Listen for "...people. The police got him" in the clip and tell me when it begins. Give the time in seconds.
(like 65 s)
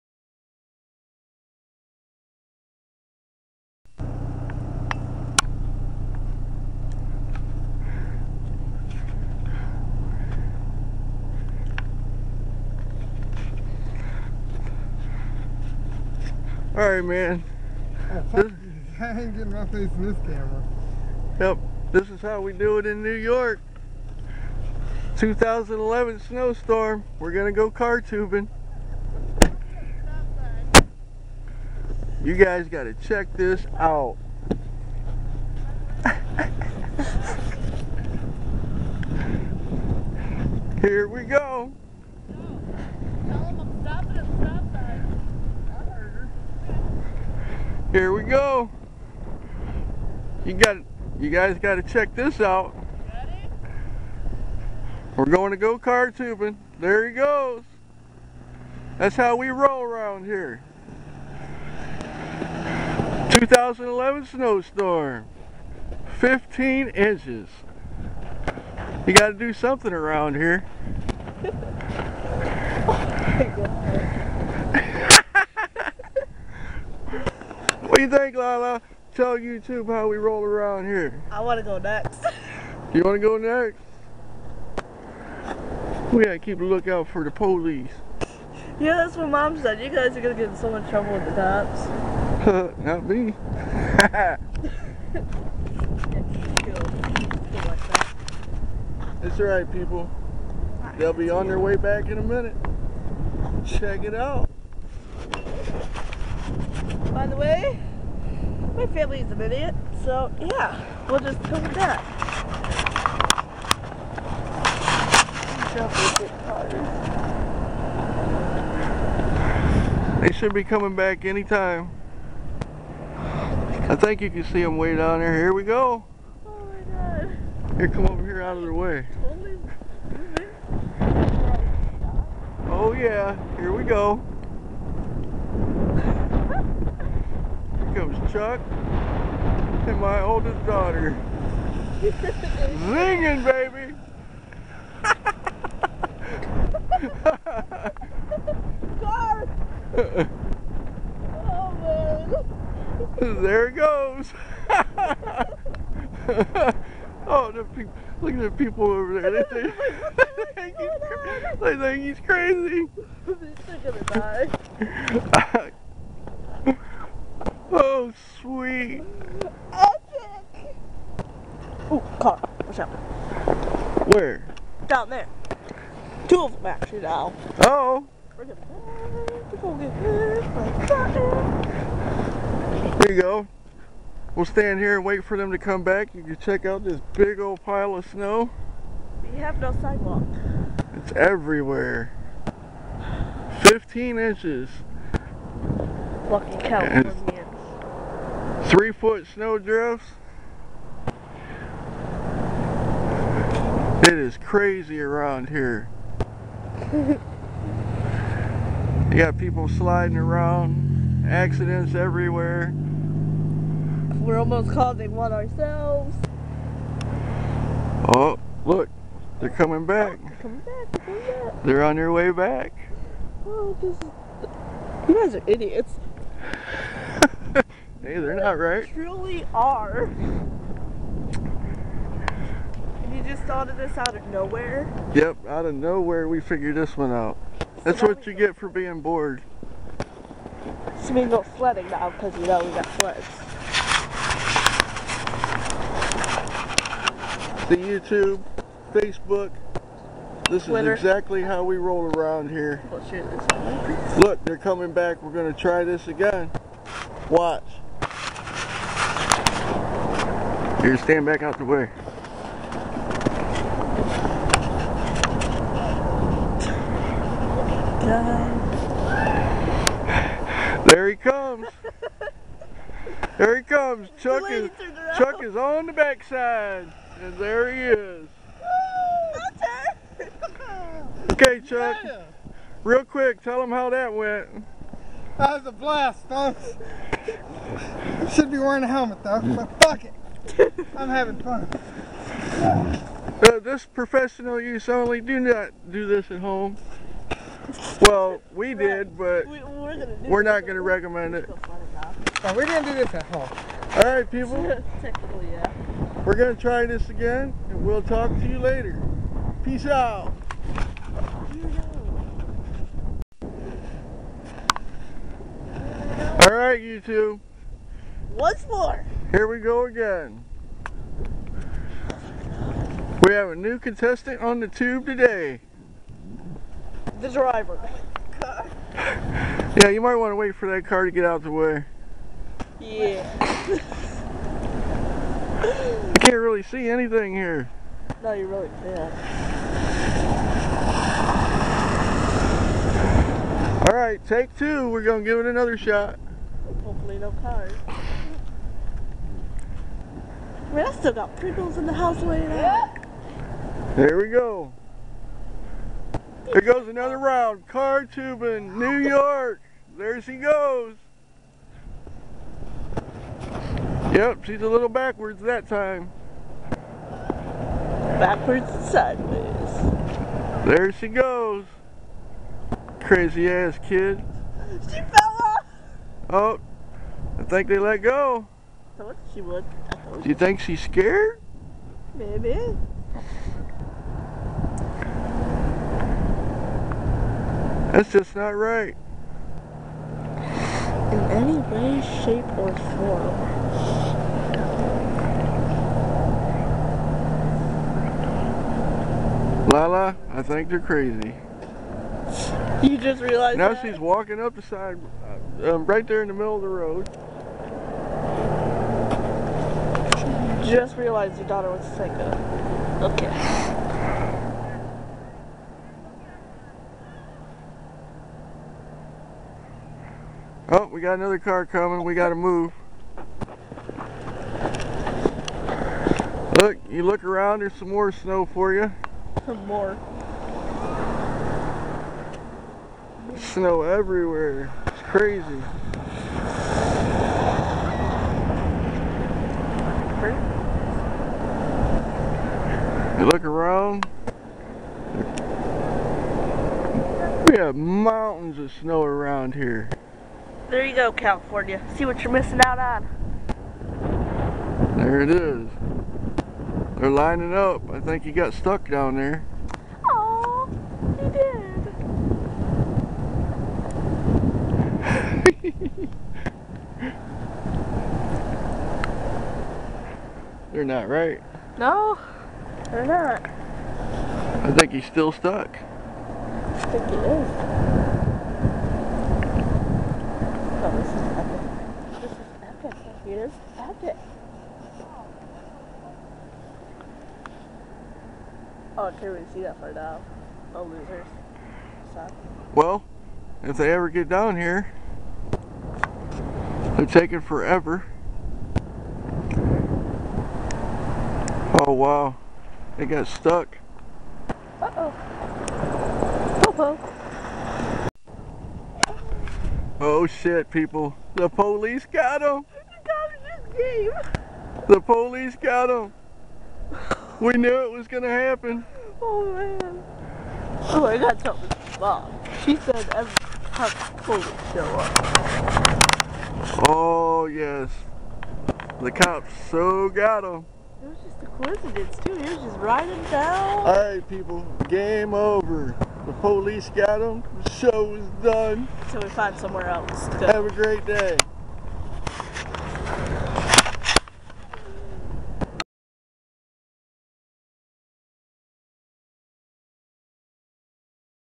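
510 s.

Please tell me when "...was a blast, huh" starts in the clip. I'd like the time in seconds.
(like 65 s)
285 s.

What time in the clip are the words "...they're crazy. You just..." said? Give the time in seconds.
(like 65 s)
400 s.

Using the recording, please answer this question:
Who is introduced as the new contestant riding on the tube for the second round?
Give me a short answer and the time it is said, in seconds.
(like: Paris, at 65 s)
The driver, at 327 s.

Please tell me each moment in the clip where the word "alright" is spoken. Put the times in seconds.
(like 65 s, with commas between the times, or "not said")
16 s, 99 s, 343 s, 533 s.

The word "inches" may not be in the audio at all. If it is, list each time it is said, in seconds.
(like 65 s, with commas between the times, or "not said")
66 s, 194 s.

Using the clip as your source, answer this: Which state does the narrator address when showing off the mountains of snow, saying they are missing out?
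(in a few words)
California.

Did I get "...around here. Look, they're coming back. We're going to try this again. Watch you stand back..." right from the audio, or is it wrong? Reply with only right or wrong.
right.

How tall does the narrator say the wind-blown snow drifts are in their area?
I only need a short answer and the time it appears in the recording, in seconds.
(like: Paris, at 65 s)
3 foot, at 198 s.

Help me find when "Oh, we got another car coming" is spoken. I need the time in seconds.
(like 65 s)
420 s.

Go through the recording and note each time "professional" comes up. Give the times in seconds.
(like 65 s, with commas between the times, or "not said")
293 s.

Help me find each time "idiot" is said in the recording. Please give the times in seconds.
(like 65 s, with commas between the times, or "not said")
109 s, 225 s.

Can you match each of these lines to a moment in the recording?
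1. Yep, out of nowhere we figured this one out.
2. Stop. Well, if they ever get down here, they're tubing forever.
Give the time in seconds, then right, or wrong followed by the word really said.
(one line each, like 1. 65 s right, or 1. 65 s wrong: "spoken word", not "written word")
1. 235 s right
2. 492 s wrong: "taking", not "tubing".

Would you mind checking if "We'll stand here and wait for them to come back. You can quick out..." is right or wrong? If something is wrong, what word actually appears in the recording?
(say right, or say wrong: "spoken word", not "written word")
wrong: "check", not "quick".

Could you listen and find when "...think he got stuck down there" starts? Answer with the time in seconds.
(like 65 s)
457 s.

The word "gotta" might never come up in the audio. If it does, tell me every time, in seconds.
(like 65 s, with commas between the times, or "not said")
86 s.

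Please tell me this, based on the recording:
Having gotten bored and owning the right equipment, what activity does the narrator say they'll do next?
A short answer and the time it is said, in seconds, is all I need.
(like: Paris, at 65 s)
Sledding, at 241 s.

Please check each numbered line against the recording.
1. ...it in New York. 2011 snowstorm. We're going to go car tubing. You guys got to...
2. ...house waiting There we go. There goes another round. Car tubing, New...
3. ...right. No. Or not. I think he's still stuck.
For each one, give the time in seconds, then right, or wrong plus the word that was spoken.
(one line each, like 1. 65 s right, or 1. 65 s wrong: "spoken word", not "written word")
1. 22 s right
2. 351 s right
3. 471 s right.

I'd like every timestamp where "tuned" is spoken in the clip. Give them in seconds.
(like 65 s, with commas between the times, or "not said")
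not said.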